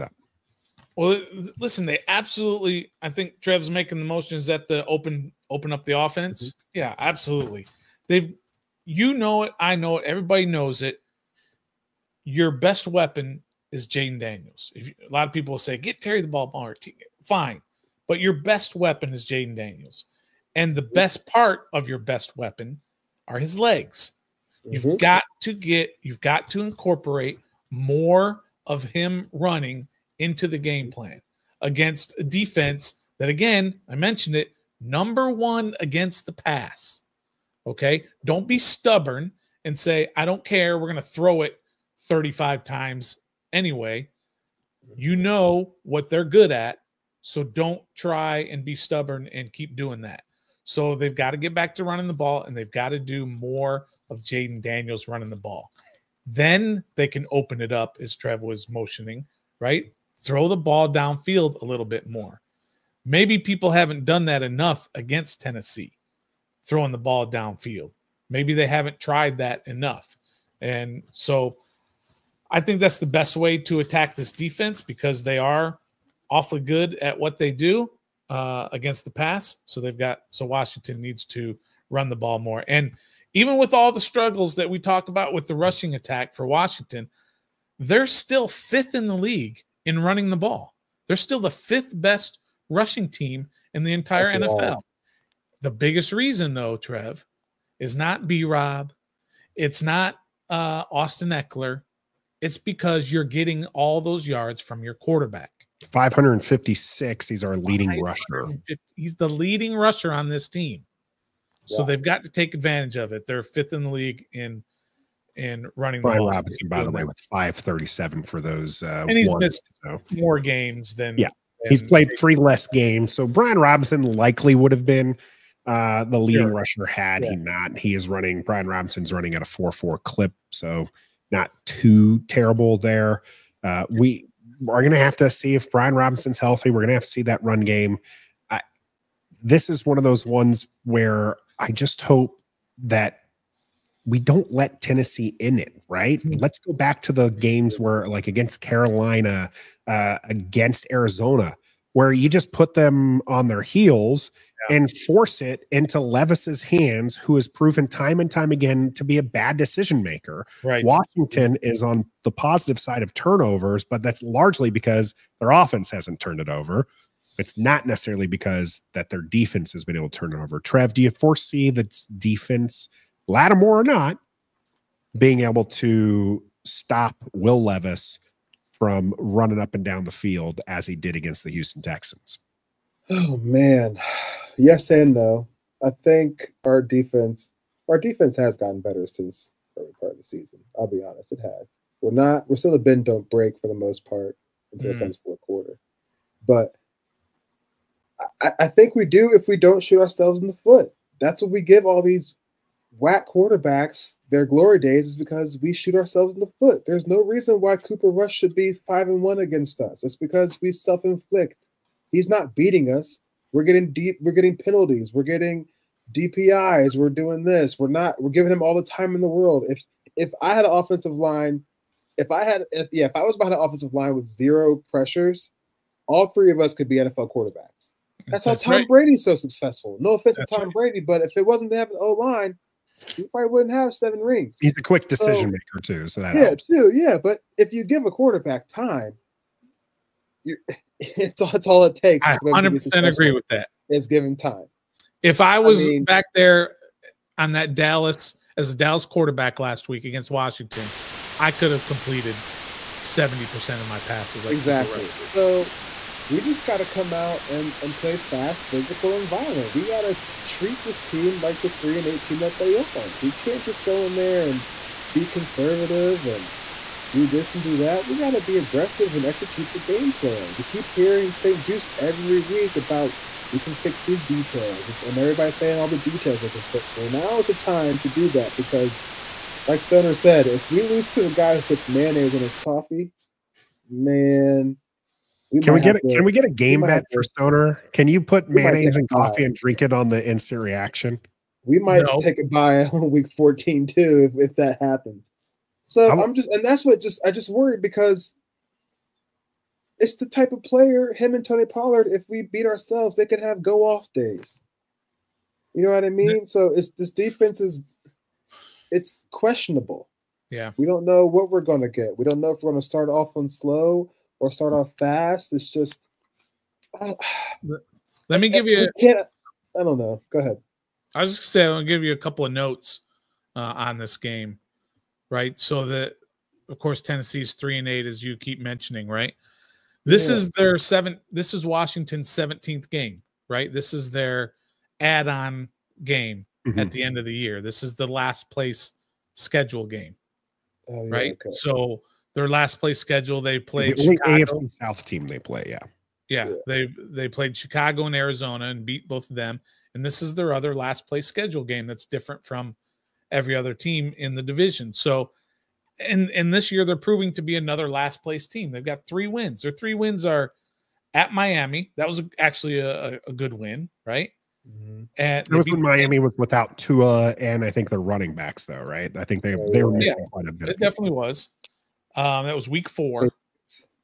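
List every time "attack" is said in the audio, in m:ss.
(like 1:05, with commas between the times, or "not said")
1:13, 1:25.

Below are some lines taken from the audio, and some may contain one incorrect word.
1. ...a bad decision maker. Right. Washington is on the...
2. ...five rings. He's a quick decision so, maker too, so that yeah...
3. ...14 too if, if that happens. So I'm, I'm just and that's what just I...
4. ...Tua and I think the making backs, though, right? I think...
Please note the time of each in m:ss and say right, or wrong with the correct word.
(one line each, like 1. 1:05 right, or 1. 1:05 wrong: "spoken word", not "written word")
1. 2:39 right
2. 3:53 wrong: "seven", not "five"
3. 4:53 right
4. 6:06 wrong: "running", not "making".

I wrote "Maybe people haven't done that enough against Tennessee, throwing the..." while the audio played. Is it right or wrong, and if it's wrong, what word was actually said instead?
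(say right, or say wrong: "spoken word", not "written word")
right.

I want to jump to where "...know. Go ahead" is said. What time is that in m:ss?
5:19.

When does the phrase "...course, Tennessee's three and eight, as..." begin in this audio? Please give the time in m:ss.
5:26.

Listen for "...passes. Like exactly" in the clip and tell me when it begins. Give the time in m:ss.
4:13.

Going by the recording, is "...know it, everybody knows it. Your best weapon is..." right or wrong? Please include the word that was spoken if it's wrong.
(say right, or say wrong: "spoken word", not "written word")
right.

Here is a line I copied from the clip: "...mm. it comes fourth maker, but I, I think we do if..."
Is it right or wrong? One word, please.
wrong.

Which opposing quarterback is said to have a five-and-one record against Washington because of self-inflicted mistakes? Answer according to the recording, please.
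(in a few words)
Cooper Rush.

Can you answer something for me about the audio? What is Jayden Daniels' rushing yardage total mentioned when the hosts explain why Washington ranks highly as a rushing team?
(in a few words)
556.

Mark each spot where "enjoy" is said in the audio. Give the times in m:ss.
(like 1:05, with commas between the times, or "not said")
not said.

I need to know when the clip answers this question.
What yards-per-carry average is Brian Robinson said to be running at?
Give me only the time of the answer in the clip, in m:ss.
2:09.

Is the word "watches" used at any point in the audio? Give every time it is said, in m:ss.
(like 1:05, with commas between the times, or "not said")
not said.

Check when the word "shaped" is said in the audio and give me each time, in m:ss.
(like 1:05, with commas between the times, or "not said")
not said.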